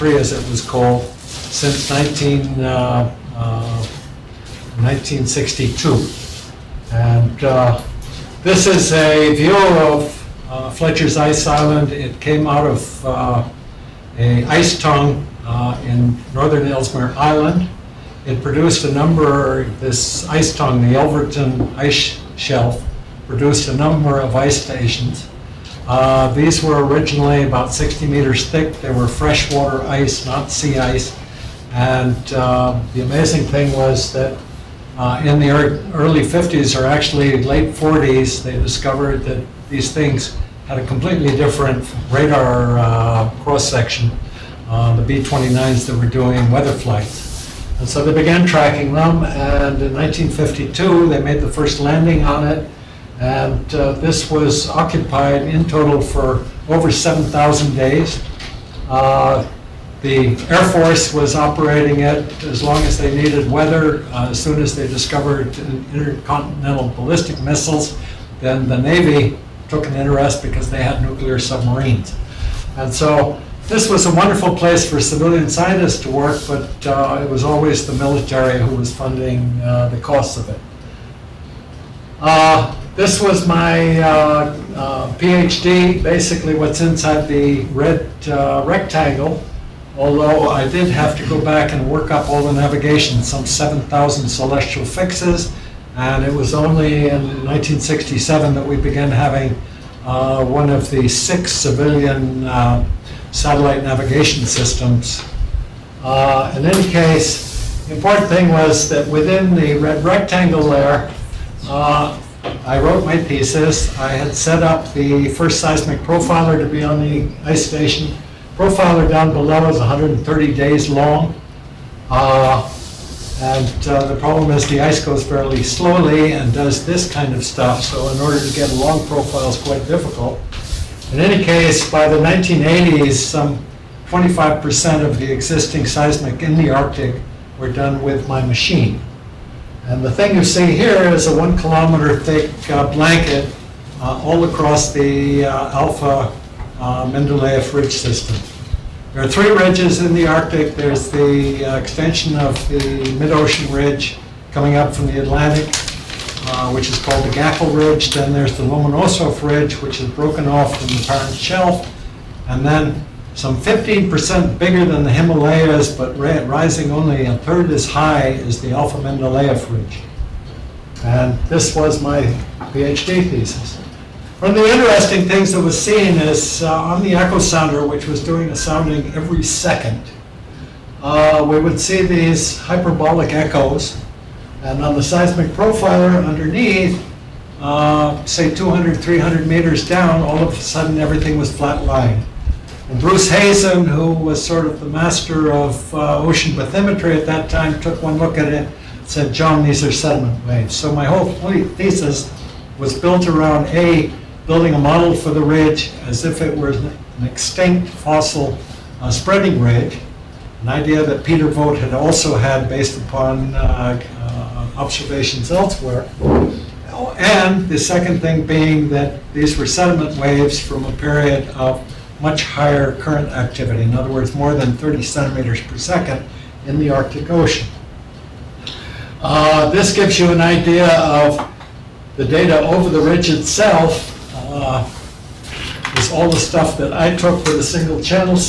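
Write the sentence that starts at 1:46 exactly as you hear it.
Uh, in any case, the important thing was that within the red rectangle there, uh, I wrote my thesis.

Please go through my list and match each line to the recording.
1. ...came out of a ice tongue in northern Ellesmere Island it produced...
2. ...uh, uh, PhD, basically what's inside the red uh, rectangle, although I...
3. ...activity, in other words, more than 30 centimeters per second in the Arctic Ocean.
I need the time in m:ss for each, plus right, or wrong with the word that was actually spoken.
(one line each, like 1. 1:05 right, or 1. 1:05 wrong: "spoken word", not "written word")
1. 0:12 right
2. 1:23 right
3. 3:43 right.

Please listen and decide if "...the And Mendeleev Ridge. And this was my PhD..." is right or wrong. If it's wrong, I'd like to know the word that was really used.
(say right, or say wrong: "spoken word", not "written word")
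wrong: "Alpha", not "And".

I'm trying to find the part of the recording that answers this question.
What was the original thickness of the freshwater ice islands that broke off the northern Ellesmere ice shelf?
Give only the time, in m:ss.
0:27.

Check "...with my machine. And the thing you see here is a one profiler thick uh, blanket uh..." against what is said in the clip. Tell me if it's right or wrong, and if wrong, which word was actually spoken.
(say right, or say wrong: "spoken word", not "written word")
wrong: "kilometer", not "profiler".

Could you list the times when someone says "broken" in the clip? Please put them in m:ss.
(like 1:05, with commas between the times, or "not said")
2:40.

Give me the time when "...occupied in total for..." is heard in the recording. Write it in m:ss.
0:54.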